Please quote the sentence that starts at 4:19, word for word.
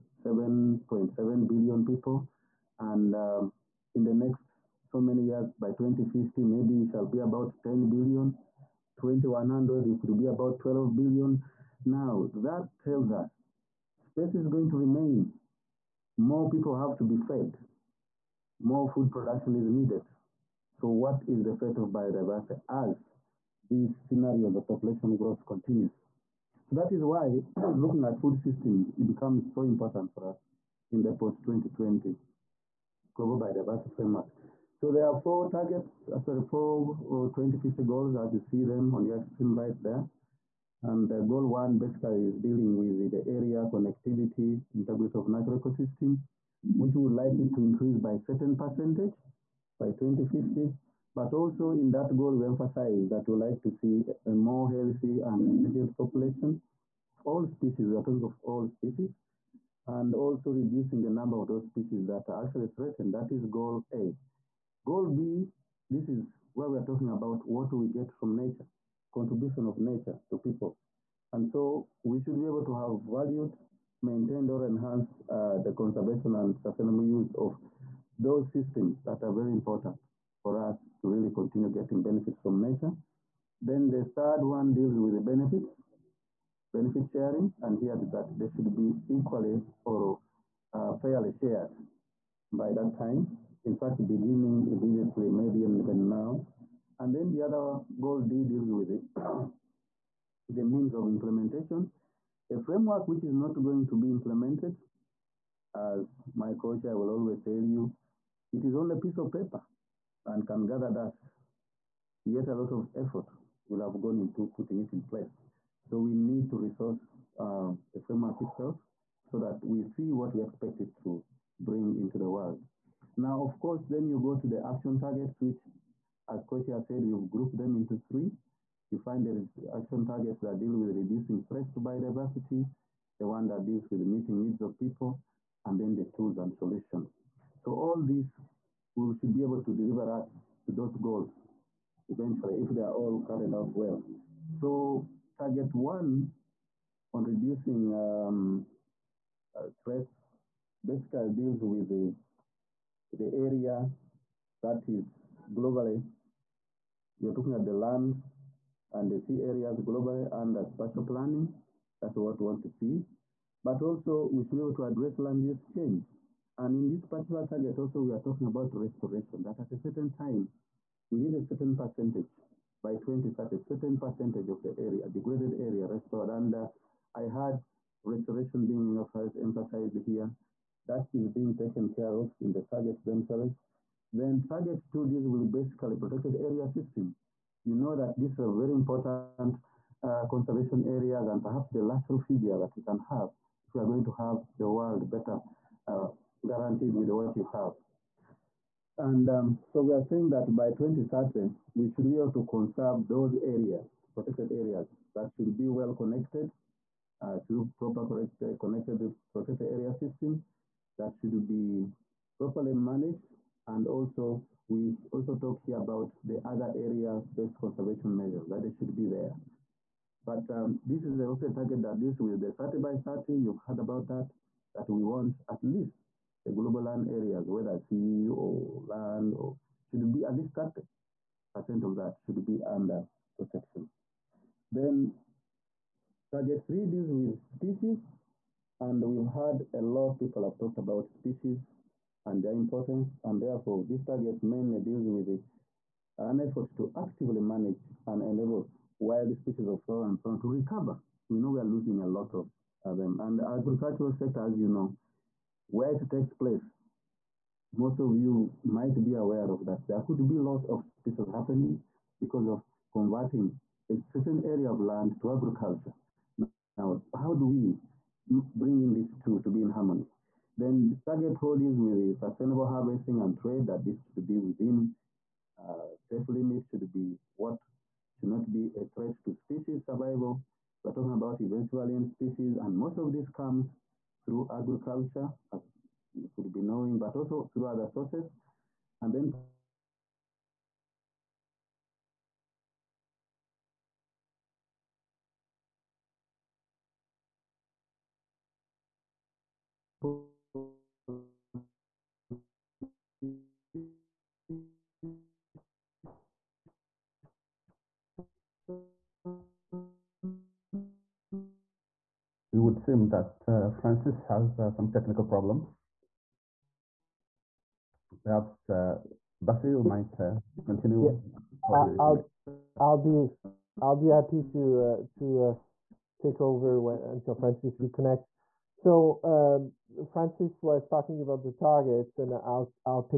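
There could be loss of species happening because of converting a certain area of land to agriculture.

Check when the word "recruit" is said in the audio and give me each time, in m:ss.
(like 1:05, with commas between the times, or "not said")
not said.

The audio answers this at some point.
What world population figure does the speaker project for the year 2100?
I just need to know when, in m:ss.
0:10.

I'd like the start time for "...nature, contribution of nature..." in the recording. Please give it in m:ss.
1:08.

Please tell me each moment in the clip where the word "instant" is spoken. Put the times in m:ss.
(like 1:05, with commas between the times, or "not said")
not said.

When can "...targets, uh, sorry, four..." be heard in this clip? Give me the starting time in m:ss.
0:35.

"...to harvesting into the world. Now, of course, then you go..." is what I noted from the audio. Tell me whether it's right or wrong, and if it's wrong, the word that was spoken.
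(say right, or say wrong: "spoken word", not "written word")
wrong: "bring", not "harvesting".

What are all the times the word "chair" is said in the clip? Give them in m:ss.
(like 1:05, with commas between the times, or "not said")
1:46, 2:06.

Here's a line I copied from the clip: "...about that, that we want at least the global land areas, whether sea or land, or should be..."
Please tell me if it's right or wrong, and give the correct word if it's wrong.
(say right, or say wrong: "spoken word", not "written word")
right.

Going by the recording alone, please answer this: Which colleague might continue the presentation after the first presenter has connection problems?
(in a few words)
Basile.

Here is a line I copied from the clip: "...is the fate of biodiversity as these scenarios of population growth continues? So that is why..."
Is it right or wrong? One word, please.
right.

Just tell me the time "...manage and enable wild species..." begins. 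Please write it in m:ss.
4:07.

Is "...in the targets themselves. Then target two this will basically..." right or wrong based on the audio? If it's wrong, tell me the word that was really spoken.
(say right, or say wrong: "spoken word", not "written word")
right.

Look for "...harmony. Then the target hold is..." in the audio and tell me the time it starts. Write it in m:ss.
4:29.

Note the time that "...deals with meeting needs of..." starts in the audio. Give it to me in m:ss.
2:13.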